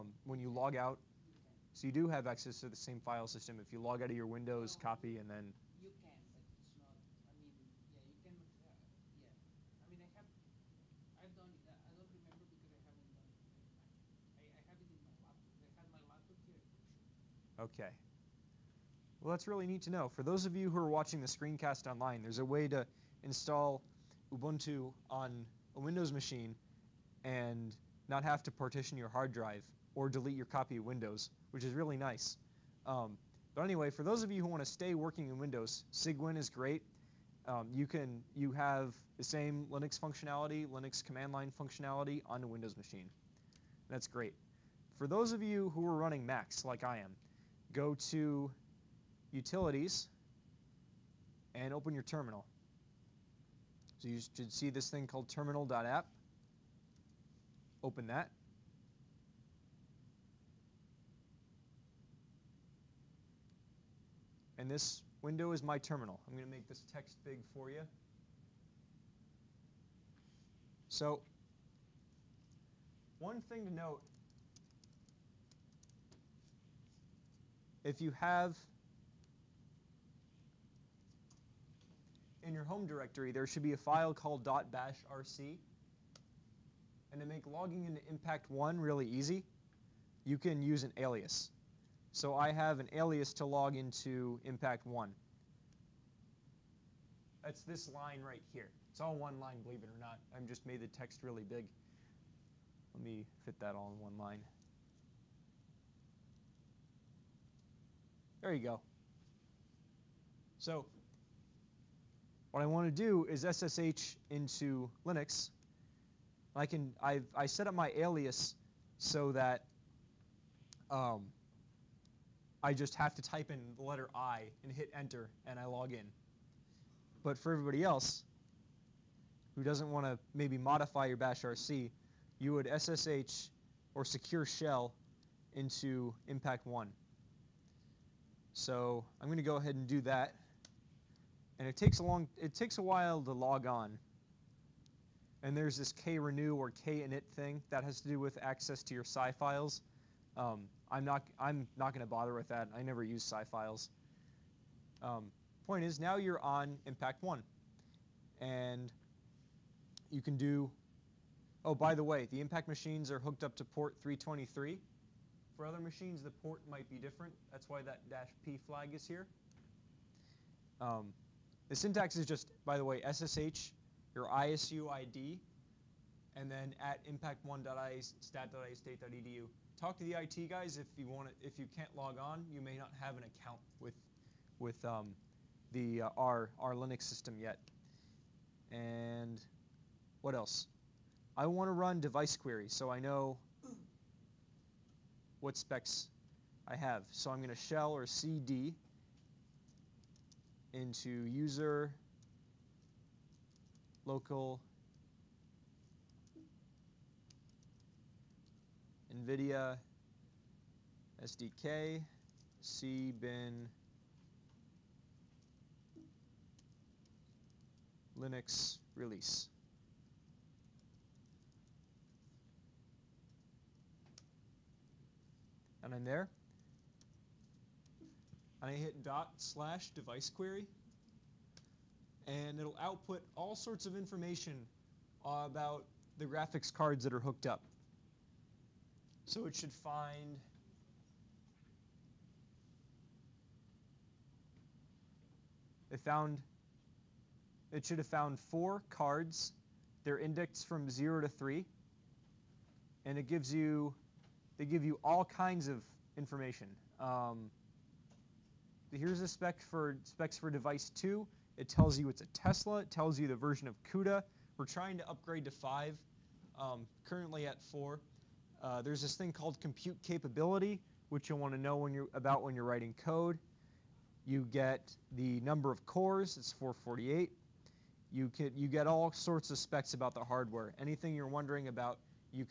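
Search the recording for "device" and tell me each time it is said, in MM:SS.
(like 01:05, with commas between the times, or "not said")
03:12, 03:49, 04:20.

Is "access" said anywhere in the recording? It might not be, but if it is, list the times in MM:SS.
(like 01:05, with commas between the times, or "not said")
00:02, 02:28.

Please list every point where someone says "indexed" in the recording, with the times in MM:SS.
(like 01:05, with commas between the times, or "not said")
04:10.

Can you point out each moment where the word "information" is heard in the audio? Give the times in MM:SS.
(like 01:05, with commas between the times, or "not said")
03:53, 04:16.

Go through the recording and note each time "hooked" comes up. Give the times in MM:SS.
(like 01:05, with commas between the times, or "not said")
02:43, 03:57.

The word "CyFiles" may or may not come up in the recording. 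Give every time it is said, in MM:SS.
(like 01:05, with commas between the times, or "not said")
02:29, 02:33.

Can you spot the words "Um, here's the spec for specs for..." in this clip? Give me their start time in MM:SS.
04:16.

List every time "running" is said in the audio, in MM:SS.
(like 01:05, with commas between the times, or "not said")
00:45.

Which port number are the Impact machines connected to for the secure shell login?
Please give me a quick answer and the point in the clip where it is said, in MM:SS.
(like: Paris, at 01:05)
323, at 02:44.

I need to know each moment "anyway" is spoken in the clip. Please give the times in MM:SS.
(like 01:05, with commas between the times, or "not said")
00:33.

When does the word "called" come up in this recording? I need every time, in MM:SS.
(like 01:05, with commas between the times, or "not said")
00:55, 01:24, 04:29.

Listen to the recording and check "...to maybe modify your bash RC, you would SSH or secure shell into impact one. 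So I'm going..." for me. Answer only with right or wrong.
right.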